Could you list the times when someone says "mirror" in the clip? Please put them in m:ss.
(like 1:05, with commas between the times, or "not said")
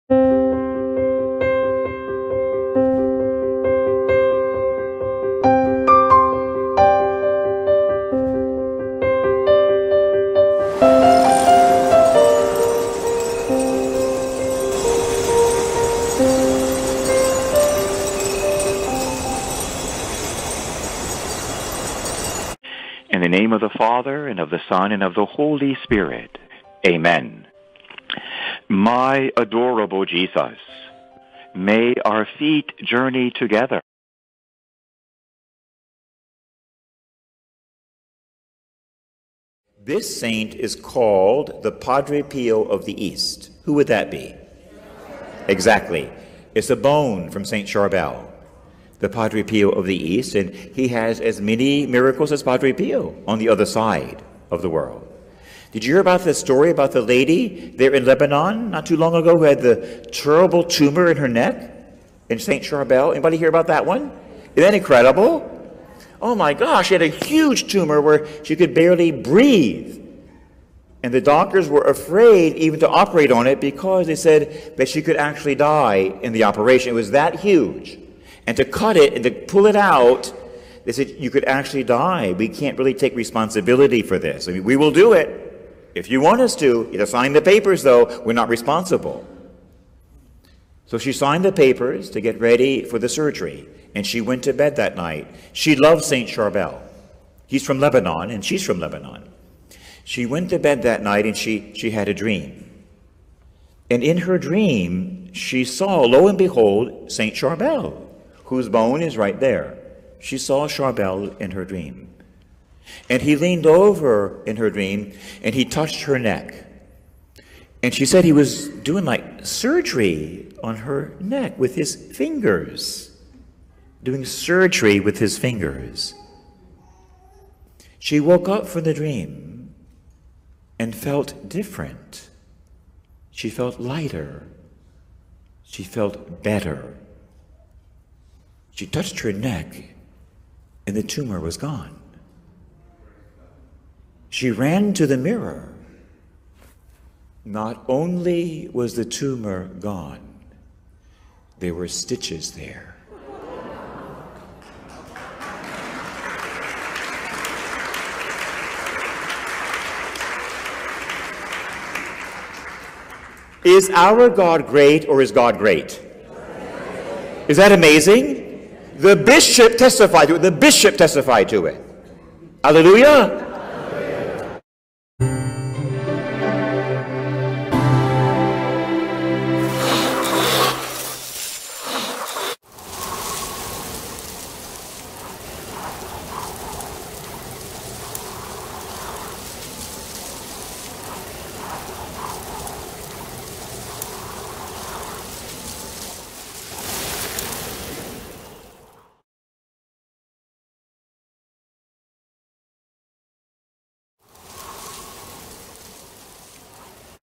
2:25.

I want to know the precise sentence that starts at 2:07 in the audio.
She woke up from the dream and felt different.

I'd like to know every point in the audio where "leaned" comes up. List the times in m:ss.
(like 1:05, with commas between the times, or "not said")
1:53.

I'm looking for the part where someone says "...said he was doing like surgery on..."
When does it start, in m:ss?
1:58.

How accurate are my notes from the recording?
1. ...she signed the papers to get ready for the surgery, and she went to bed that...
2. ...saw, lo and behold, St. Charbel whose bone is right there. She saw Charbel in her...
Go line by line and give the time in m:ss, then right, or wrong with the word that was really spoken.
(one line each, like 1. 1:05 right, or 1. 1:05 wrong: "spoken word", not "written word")
1. 1:30 right
2. 1:45 right.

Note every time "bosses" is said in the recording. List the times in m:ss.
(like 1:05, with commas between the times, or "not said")
not said.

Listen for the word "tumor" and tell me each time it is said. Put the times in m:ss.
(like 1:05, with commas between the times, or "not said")
1:00, 1:07, 2:21, 2:29.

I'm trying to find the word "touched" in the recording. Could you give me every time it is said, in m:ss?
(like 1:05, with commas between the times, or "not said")
1:55, 2:18.